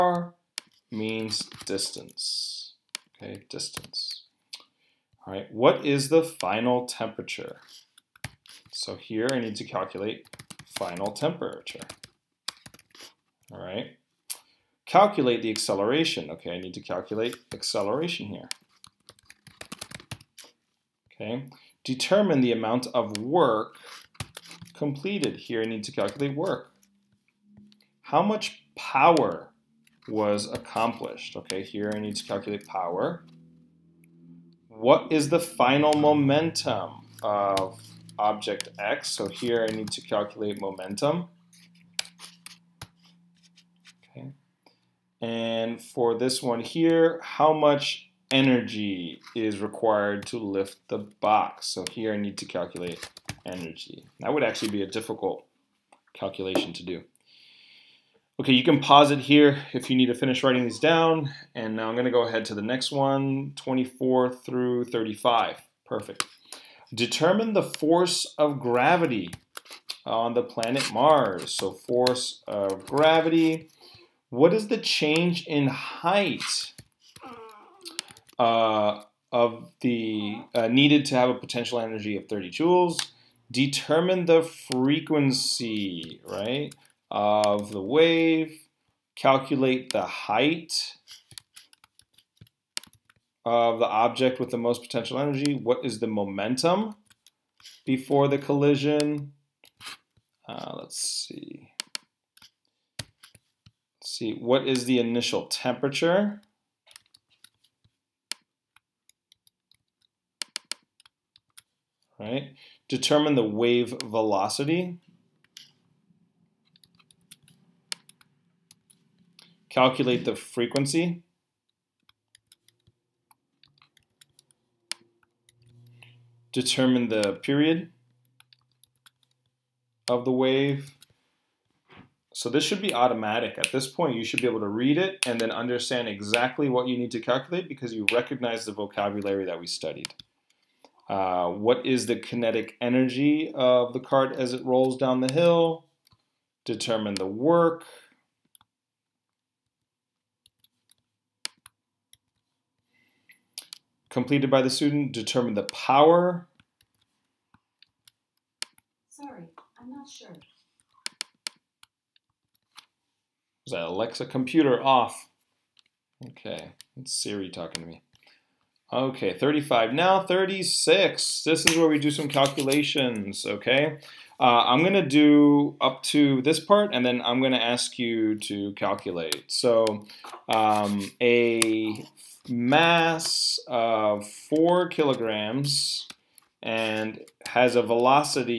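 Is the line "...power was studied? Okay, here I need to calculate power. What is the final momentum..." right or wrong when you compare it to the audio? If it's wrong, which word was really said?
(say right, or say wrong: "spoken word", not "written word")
wrong: "accomplished", not "studied".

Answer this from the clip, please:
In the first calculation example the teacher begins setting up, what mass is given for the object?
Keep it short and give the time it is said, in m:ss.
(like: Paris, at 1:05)
4 kilograms, at 3:04.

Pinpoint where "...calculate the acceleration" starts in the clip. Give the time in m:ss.
0:14.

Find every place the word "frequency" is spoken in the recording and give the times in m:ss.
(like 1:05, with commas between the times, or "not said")
1:24, 2:00.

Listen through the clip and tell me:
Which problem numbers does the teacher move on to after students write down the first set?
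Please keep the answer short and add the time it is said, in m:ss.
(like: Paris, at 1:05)
24 through 35, at 1:03.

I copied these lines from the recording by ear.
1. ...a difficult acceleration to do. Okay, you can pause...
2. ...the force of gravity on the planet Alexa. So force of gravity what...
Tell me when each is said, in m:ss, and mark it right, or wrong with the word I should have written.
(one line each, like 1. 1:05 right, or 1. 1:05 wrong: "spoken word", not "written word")
1. 0:54 wrong: "calculation", not "acceleration"
2. 1:07 wrong: "Mars", not "Alexa".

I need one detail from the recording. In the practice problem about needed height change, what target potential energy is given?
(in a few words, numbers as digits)
30 joules.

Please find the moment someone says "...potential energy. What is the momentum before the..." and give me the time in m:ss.
1:34.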